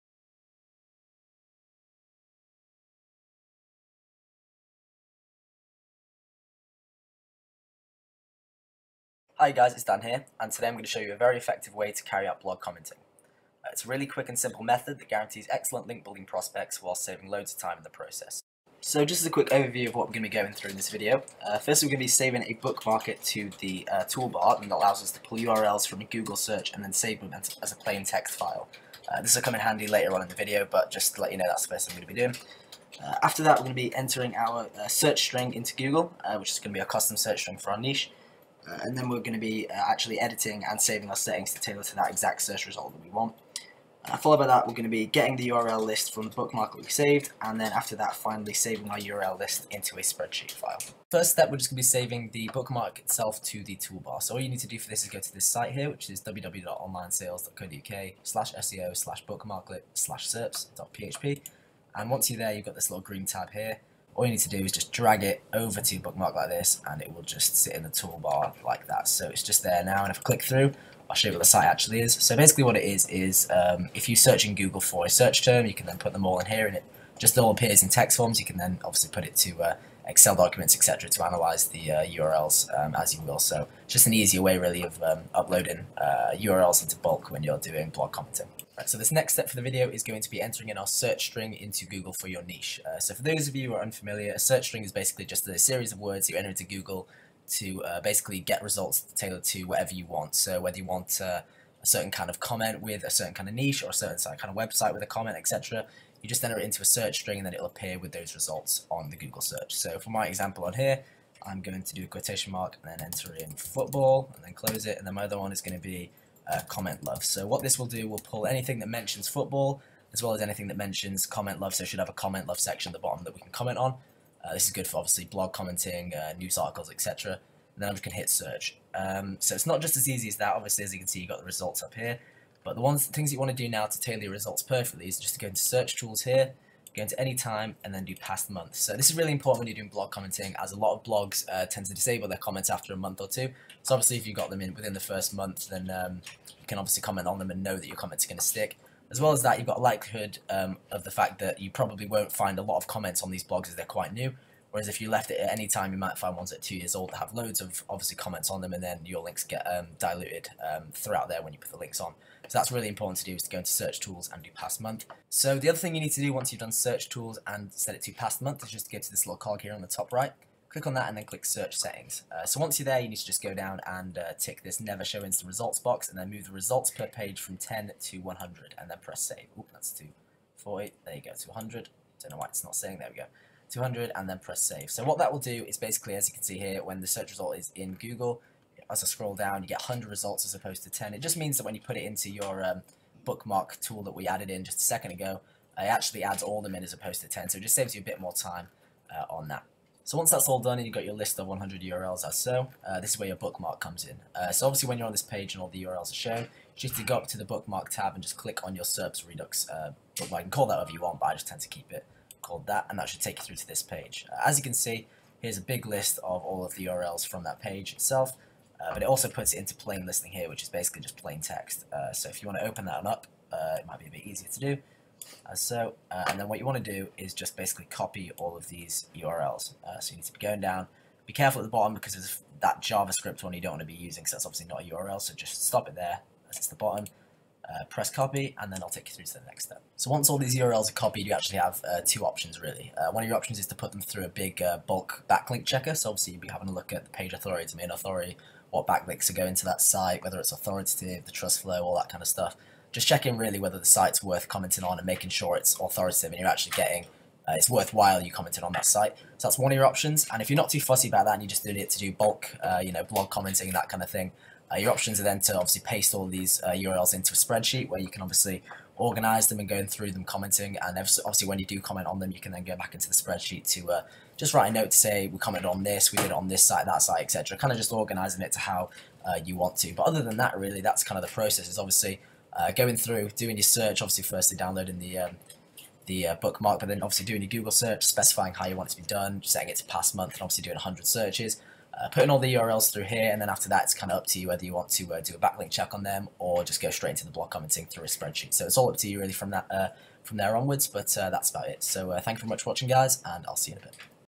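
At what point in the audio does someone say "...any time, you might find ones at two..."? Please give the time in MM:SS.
02:35.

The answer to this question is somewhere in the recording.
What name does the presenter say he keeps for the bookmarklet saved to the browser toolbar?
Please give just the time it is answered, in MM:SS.
03:28.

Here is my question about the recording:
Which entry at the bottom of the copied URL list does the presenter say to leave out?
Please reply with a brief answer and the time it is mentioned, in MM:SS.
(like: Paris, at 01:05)
JavaScript one, at 03:52.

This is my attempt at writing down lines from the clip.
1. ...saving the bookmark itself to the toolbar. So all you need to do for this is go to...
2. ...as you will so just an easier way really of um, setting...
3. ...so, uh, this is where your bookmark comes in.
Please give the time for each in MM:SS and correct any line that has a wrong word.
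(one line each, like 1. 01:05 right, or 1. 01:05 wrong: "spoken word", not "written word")
1. 00:51 right
2. 01:22 wrong: "uploading", not "setting"
3. 03:22 right.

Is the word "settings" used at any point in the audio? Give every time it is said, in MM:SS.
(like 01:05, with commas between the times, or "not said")
00:41, 02:51, 04:49.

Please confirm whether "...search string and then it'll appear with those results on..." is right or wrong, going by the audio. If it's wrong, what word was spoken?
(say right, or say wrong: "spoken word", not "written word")
right.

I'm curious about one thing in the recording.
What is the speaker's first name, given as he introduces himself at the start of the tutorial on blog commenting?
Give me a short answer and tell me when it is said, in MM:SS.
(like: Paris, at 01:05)
Dan, at 00:09.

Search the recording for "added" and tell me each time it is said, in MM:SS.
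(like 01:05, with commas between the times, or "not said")
03:14.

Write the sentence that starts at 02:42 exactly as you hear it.
So that's really important to do is to go into search tools and do past month.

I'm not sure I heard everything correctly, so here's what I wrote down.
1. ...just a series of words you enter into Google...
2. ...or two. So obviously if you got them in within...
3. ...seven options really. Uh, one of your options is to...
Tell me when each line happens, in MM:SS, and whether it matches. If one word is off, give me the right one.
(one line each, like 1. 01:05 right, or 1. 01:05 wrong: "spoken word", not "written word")
1. 01:35 right
2. 02:23 right
3. 04:02 wrong: "two", not "seven".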